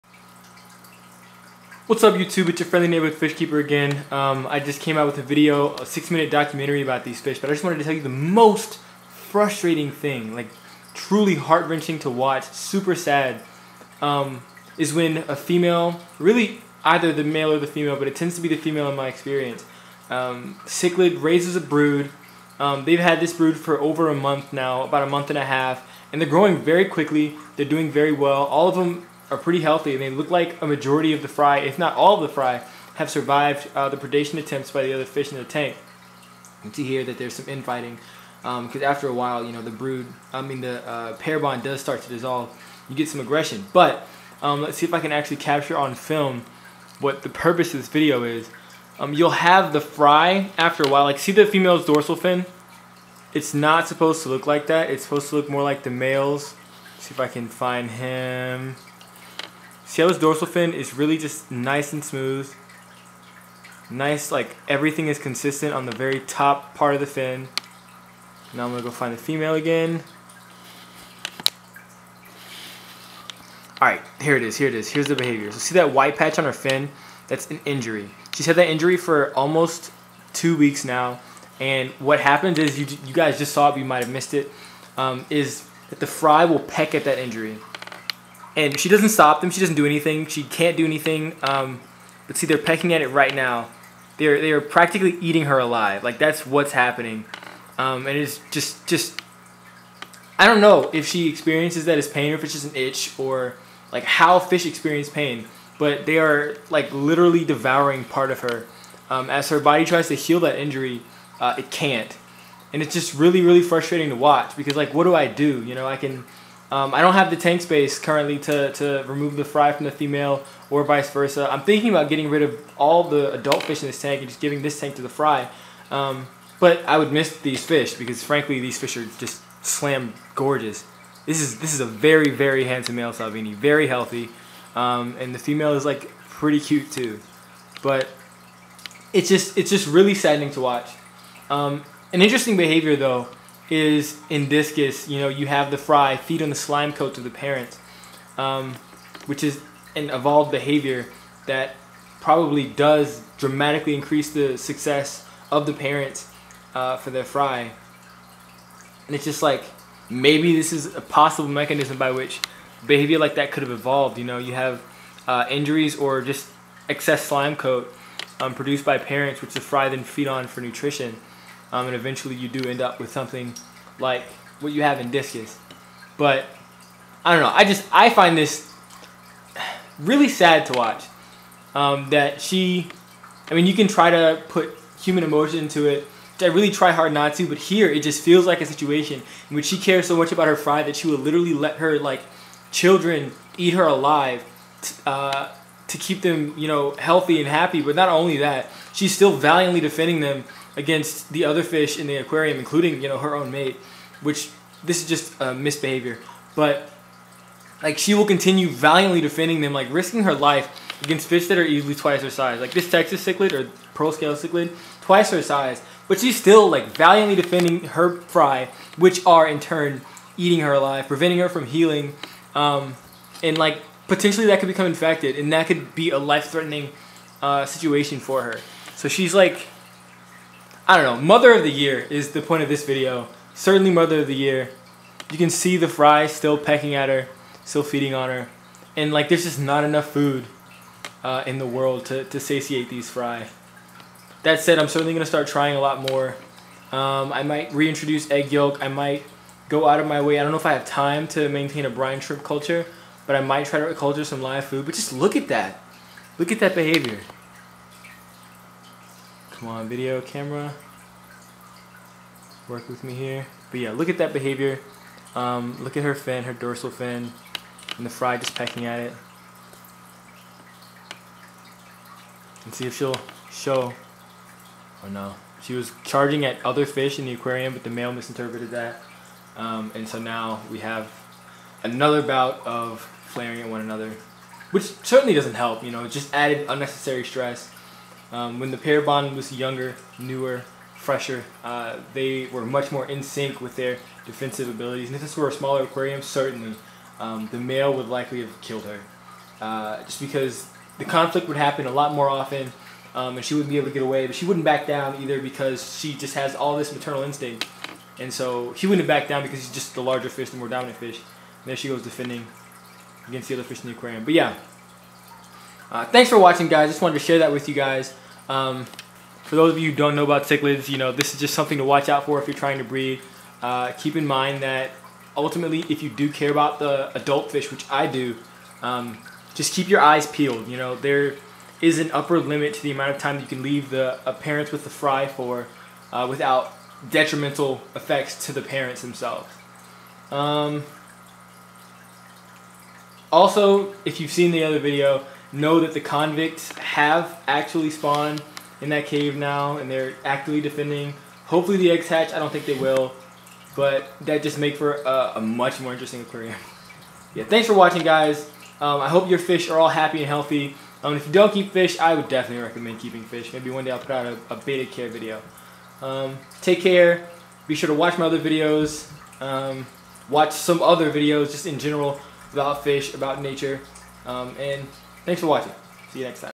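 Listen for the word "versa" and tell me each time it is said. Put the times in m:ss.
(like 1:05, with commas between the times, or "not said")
2:01.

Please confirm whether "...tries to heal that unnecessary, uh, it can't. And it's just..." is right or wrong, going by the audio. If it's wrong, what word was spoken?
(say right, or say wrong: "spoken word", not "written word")
wrong: "injury", not "unnecessary".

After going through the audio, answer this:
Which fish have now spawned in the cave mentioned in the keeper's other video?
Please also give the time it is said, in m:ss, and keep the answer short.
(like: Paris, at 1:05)
Convicts, at 5:46.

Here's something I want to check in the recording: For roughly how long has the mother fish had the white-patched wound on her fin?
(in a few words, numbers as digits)
Almost two weeks.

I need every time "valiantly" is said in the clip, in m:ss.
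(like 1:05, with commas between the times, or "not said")
3:19, 3:28, 3:36.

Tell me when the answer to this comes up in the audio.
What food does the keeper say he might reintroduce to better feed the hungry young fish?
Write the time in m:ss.
4:08.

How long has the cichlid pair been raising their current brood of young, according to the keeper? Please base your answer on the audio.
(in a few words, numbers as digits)
About a month and a half.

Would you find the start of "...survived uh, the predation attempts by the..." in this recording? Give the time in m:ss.
0:33.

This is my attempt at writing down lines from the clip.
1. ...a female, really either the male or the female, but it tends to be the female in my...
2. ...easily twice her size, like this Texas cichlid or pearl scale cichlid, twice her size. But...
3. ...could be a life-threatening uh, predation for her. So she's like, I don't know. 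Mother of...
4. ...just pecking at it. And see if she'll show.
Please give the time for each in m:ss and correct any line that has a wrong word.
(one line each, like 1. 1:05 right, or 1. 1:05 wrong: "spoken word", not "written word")
1. 0:15 right
2. 3:31 right
3. 3:45 wrong: "situation", not "predation"
4. 4:28 right.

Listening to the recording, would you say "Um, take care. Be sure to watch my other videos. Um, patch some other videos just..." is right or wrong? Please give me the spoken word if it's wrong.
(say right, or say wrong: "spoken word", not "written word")
wrong: "watch", not "patch".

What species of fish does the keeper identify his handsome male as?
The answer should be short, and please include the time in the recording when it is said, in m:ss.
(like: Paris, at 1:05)
Salvini, at 2:13.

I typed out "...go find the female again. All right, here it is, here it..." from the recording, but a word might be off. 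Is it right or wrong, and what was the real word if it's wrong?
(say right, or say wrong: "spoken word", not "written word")
right.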